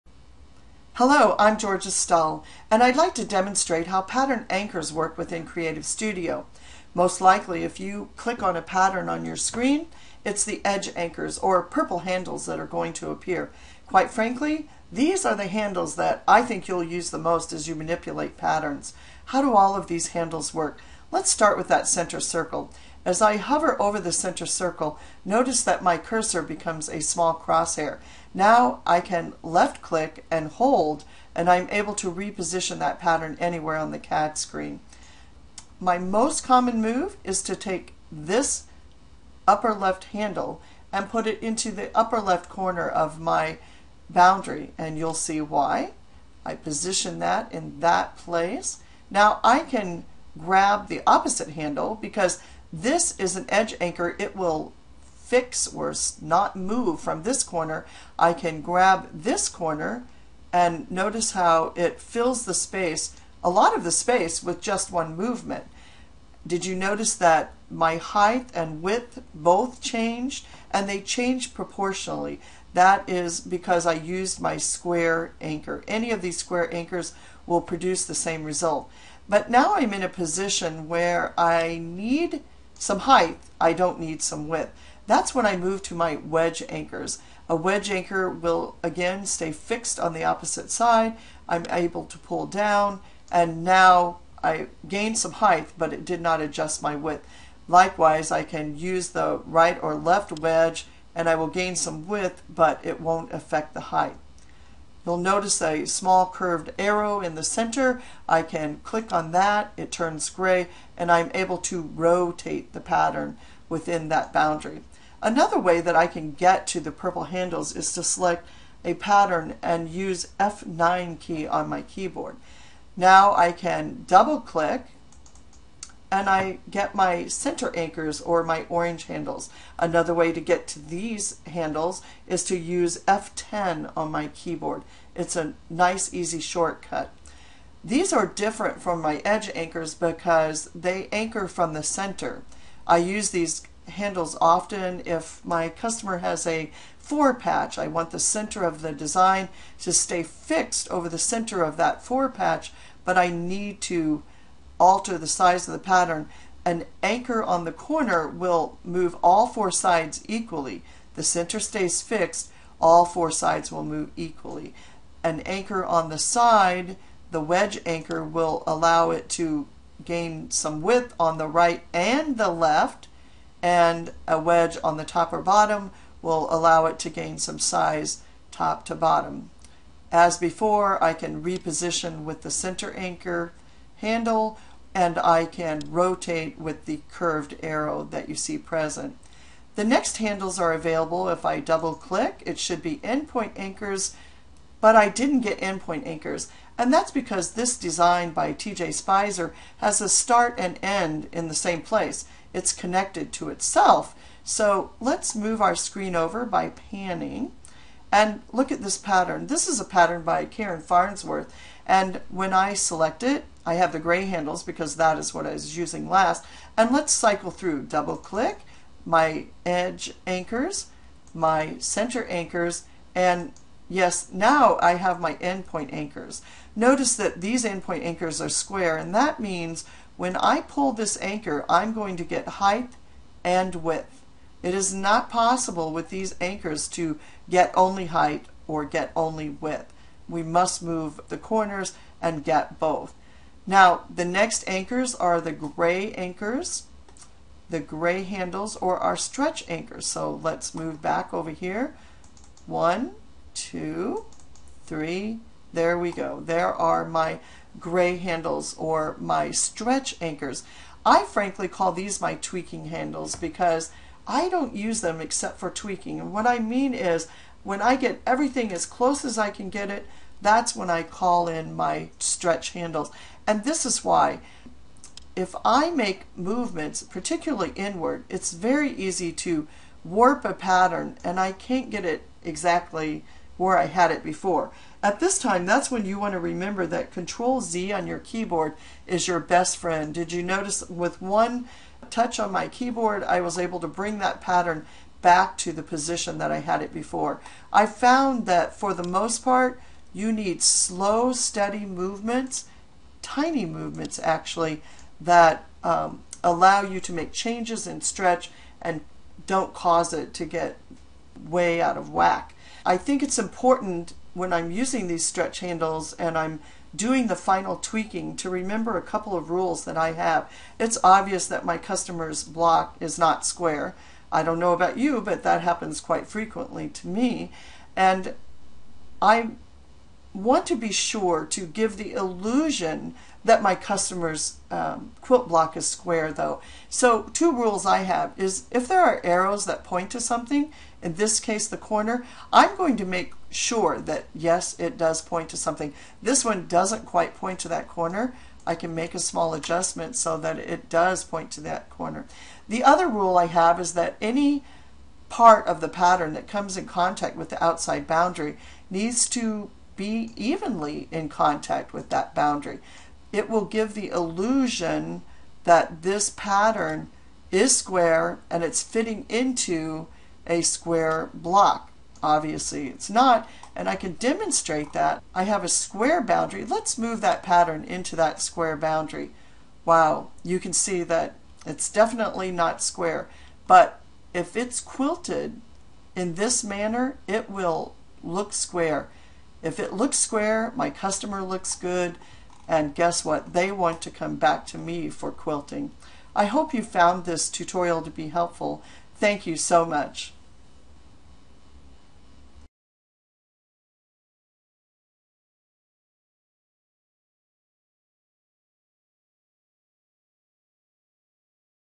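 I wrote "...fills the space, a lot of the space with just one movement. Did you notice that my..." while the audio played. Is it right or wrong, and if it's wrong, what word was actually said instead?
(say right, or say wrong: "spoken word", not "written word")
right.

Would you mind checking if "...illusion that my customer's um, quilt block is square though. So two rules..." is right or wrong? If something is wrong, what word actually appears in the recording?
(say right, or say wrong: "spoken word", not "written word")
right.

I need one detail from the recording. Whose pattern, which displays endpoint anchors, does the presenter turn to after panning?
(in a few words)
Karen Farnsworth.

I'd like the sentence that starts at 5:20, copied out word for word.
It's obvious that my customer's block is not square.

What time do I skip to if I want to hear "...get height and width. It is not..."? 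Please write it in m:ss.
3:52.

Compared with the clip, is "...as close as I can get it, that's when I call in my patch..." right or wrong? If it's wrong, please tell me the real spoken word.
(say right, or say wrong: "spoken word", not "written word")
wrong: "stretch", not "patch".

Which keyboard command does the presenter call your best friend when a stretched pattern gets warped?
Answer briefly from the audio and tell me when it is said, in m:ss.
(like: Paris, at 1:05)
Control Z, at 4:47.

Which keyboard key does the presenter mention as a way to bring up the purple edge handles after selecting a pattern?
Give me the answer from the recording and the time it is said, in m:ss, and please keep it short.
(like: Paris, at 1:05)
F9, at 2:00.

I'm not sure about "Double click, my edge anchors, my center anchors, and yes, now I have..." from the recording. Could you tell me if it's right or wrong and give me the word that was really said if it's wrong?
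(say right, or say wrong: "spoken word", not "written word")
right.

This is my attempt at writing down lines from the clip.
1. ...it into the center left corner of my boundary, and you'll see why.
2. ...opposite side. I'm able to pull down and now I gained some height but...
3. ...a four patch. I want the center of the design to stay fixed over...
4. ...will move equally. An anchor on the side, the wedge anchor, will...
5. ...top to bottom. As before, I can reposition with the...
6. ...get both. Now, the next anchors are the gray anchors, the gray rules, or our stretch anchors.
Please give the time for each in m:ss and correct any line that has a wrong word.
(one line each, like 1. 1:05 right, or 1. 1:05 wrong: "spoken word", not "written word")
1. 0:41 wrong: "upper", not "center"
2. 1:30 right
3. 2:26 right
4. 2:43 right
5. 2:58 right
6. 4:02 wrong: "handles", not "rules".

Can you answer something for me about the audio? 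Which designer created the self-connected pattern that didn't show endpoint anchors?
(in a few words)
TJ Spicer.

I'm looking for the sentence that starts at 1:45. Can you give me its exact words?
You'll notice a small curved arrow in the center.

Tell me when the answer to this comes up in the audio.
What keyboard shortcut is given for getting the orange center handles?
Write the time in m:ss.
2:13.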